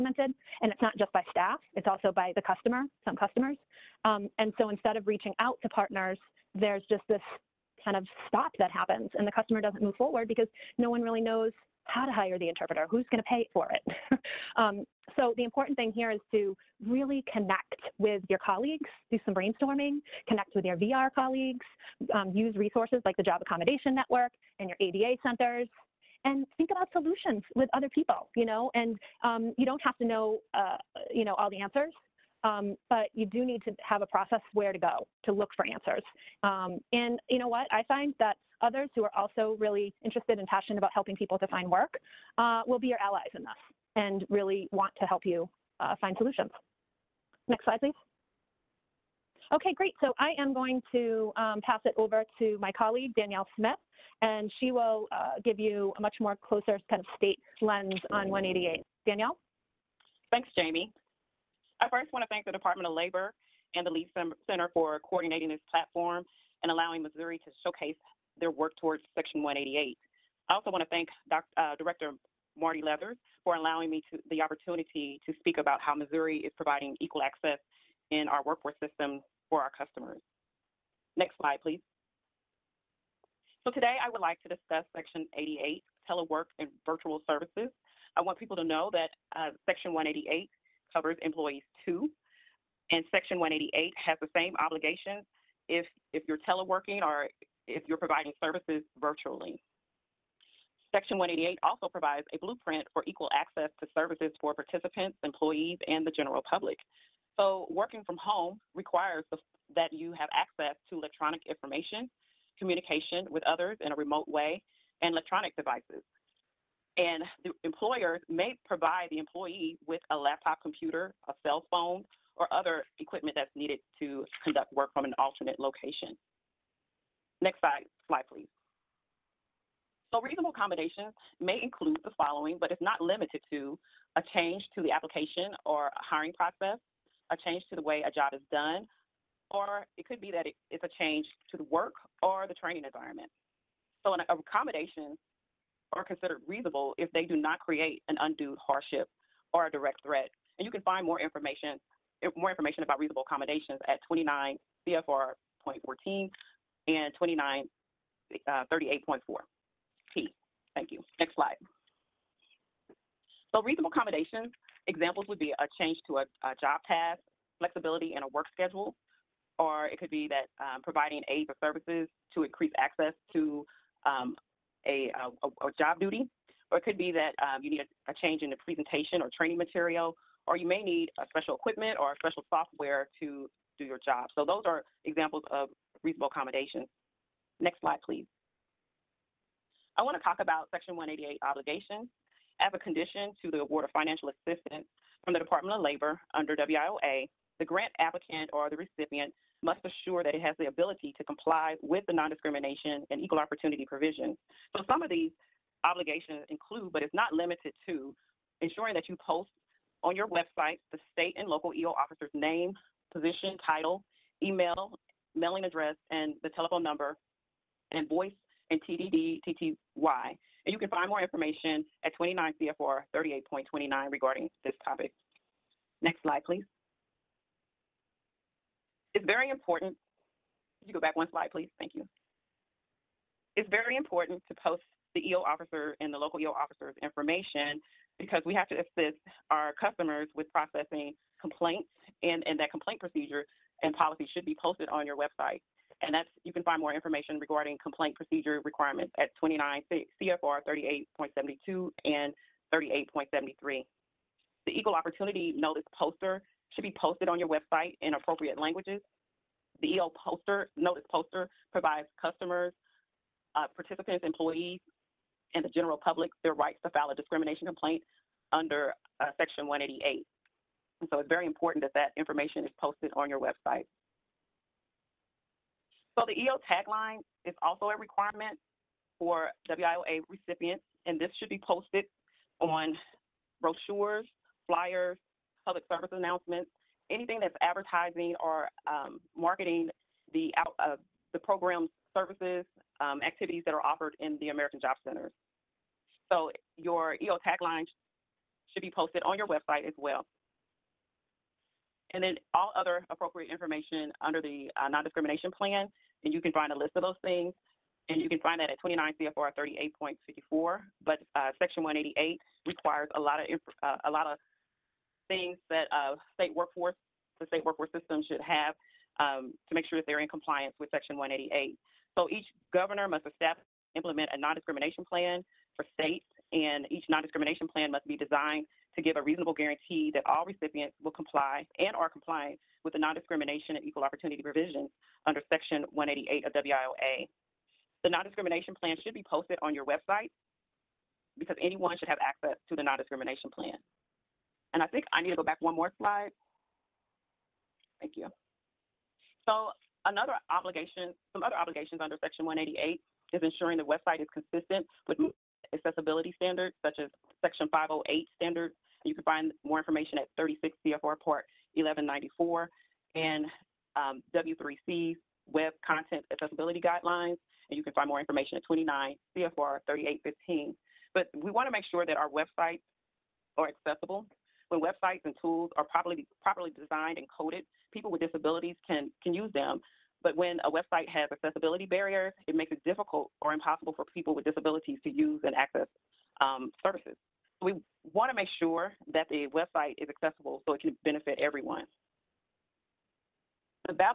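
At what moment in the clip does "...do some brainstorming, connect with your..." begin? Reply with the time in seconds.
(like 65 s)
19 s.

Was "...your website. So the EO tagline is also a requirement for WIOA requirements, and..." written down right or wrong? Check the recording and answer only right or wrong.
wrong.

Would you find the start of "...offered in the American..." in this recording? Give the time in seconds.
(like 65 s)
293 s.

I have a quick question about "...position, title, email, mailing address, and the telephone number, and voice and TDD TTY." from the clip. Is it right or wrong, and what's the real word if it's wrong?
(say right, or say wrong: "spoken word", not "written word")
right.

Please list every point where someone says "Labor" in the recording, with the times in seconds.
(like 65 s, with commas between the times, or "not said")
62 s, 195 s.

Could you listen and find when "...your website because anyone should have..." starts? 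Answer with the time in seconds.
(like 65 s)
339 s.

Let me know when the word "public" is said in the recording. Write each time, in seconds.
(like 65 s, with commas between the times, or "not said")
106 s, 266 s, 285 s.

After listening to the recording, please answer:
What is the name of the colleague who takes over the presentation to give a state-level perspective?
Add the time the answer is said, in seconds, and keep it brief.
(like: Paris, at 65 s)
Danielle Smith, at 53 s.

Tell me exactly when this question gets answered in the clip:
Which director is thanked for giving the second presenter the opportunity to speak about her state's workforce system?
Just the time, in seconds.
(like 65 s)
72 s.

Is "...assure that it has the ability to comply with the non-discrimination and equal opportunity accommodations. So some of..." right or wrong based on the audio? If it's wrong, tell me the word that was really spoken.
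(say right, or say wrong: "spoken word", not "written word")
wrong: "provisions", not "accommodations".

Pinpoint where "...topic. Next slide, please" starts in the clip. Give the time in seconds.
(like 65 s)
224 s.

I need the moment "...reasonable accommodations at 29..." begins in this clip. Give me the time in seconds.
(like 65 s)
152 s.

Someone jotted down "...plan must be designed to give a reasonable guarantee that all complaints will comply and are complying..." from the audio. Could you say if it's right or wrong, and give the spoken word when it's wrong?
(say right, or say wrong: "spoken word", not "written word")
wrong: "recipients", not "complaints".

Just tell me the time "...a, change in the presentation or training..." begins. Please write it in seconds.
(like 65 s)
178 s.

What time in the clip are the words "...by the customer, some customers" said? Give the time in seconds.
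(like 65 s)
2 s.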